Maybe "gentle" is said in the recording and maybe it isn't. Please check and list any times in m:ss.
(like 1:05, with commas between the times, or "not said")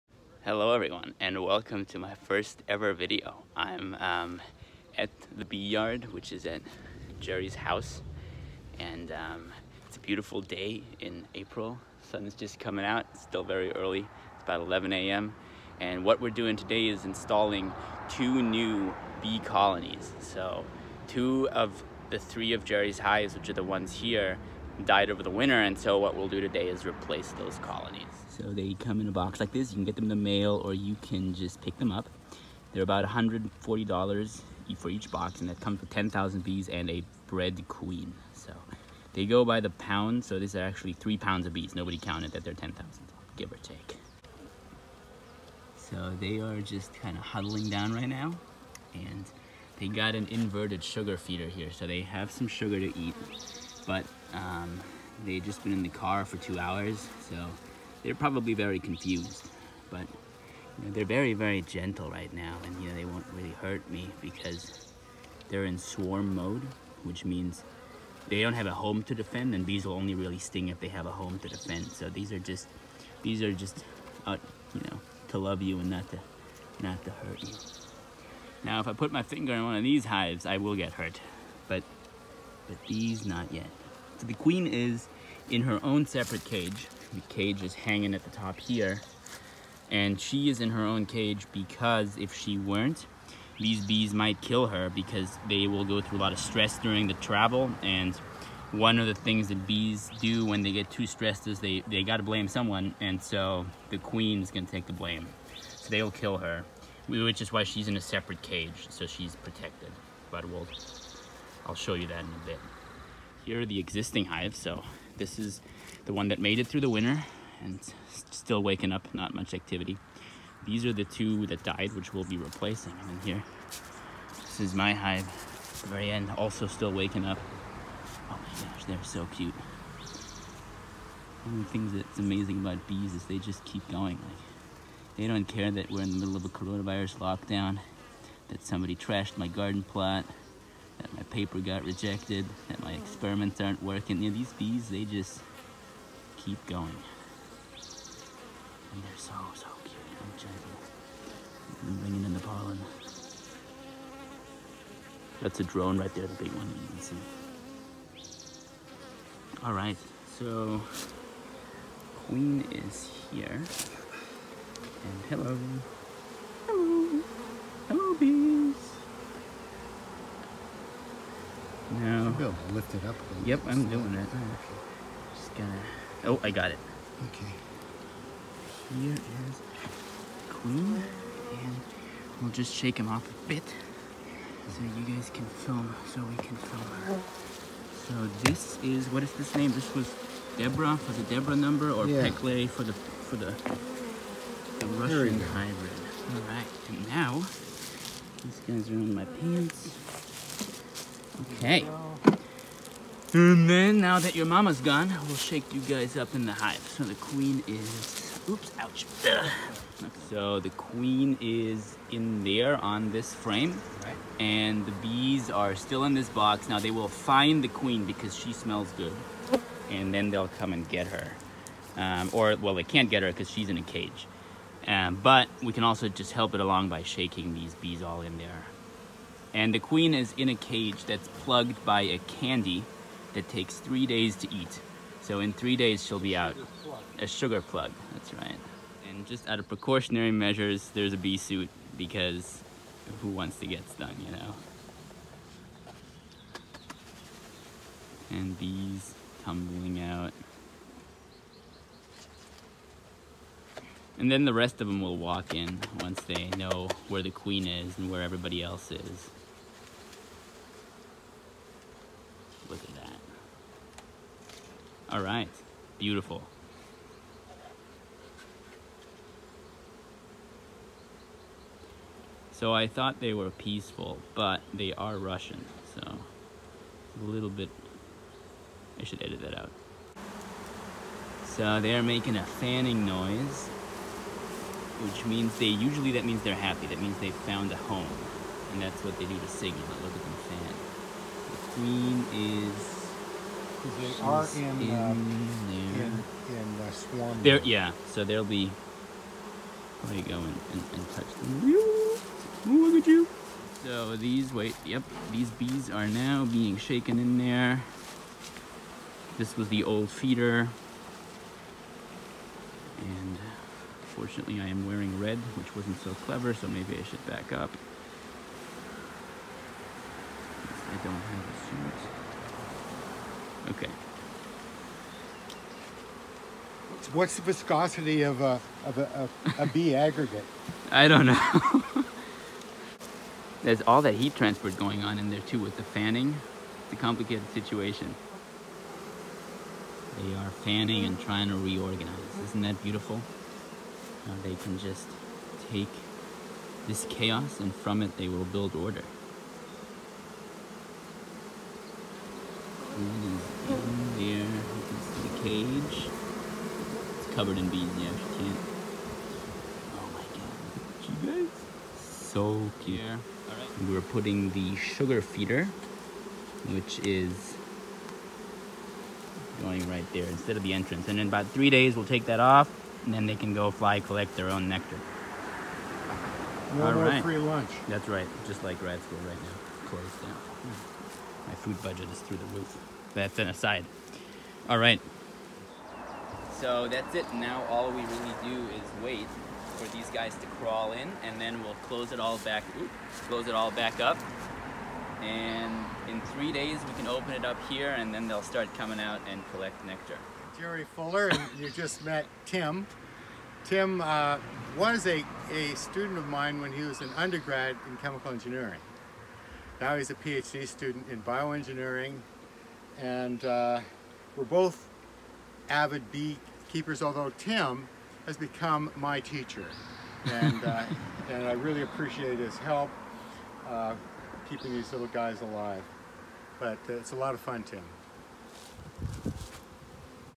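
1:01, 2:30.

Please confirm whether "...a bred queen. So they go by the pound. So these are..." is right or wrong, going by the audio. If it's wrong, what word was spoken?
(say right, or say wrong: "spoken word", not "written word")
right.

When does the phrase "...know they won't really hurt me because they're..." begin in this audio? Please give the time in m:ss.
1:02.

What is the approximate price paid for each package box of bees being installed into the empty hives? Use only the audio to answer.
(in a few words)
$140.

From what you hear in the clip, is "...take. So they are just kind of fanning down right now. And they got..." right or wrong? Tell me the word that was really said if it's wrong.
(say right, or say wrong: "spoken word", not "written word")
wrong: "huddling", not "fanning".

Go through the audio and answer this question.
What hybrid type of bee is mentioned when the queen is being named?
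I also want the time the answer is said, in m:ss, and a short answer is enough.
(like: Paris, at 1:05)
Russian hybrid, at 3:14.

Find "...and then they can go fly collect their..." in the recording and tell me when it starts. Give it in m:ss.
6:13.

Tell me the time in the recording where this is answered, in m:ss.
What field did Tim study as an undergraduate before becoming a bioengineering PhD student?
6:47.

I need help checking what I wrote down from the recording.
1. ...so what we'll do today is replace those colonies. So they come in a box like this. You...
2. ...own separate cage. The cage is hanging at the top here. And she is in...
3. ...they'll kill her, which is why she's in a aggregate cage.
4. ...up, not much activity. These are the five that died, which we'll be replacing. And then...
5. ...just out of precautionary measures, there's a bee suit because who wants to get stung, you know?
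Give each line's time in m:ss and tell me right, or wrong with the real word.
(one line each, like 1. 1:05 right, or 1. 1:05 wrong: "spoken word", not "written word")
1. 0:25 right
2. 1:25 right
3. 1:45 wrong: "separate", not "aggregate"
4. 1:58 wrong: "two", not "five"
5. 3:59 right.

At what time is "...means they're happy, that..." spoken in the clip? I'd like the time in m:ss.
4:46.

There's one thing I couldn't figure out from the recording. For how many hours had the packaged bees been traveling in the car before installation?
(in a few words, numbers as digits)
2.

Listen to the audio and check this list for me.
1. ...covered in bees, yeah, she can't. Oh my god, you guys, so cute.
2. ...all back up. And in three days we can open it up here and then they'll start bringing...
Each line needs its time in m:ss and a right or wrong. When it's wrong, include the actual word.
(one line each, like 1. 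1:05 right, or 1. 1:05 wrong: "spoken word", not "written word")
1. 5:57 right
2. 6:33 wrong: "coming", not "bringing".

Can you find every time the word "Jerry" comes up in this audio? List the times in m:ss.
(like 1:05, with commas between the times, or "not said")
0:07, 0:22, 6:40.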